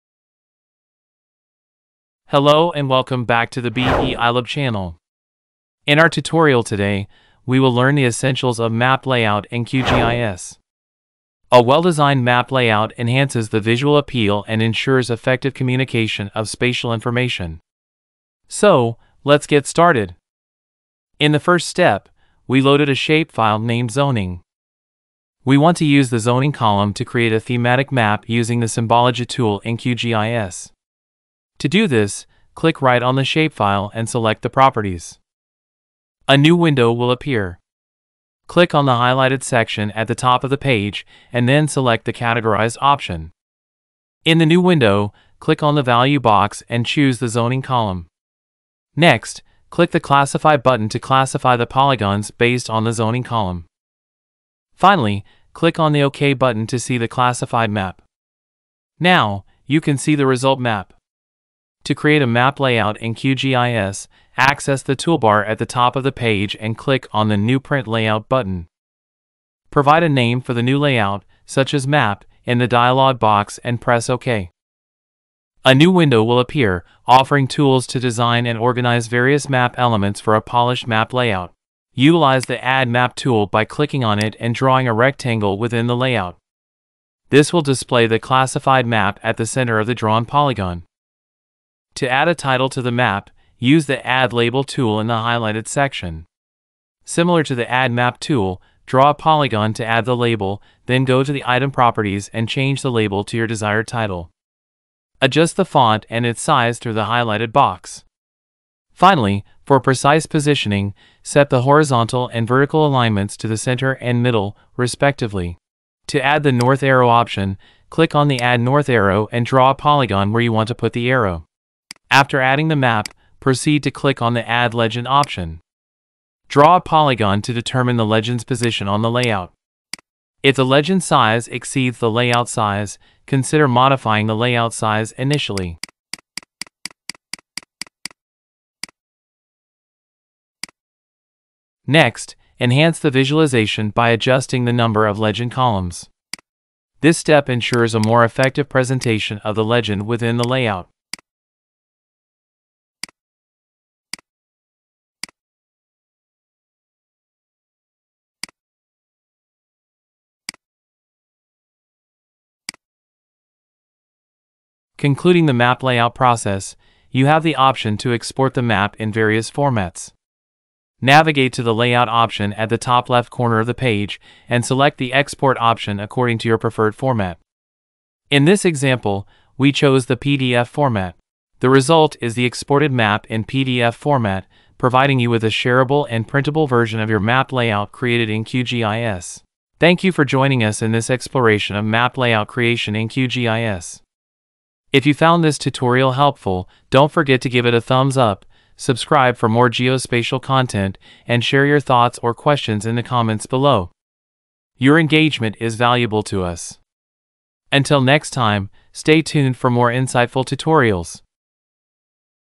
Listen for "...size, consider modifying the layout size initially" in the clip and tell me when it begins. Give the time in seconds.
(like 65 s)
132 s.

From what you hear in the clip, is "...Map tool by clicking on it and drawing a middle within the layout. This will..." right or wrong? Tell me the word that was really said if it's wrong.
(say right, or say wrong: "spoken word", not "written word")
wrong: "rectangle", not "middle".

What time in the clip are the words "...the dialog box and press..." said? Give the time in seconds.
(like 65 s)
72 s.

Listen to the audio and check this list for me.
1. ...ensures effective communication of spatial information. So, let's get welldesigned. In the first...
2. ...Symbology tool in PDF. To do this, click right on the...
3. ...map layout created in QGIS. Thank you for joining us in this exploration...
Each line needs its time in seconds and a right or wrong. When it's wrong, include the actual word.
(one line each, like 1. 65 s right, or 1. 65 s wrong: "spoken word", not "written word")
1. 14 s wrong: "started", not "welldesigned"
2. 28 s wrong: "QGIS", not "PDF"
3. 187 s right.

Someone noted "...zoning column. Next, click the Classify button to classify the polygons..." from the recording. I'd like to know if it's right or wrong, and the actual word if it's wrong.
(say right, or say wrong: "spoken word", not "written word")
right.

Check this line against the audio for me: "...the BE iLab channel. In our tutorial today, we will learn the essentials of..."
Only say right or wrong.
right.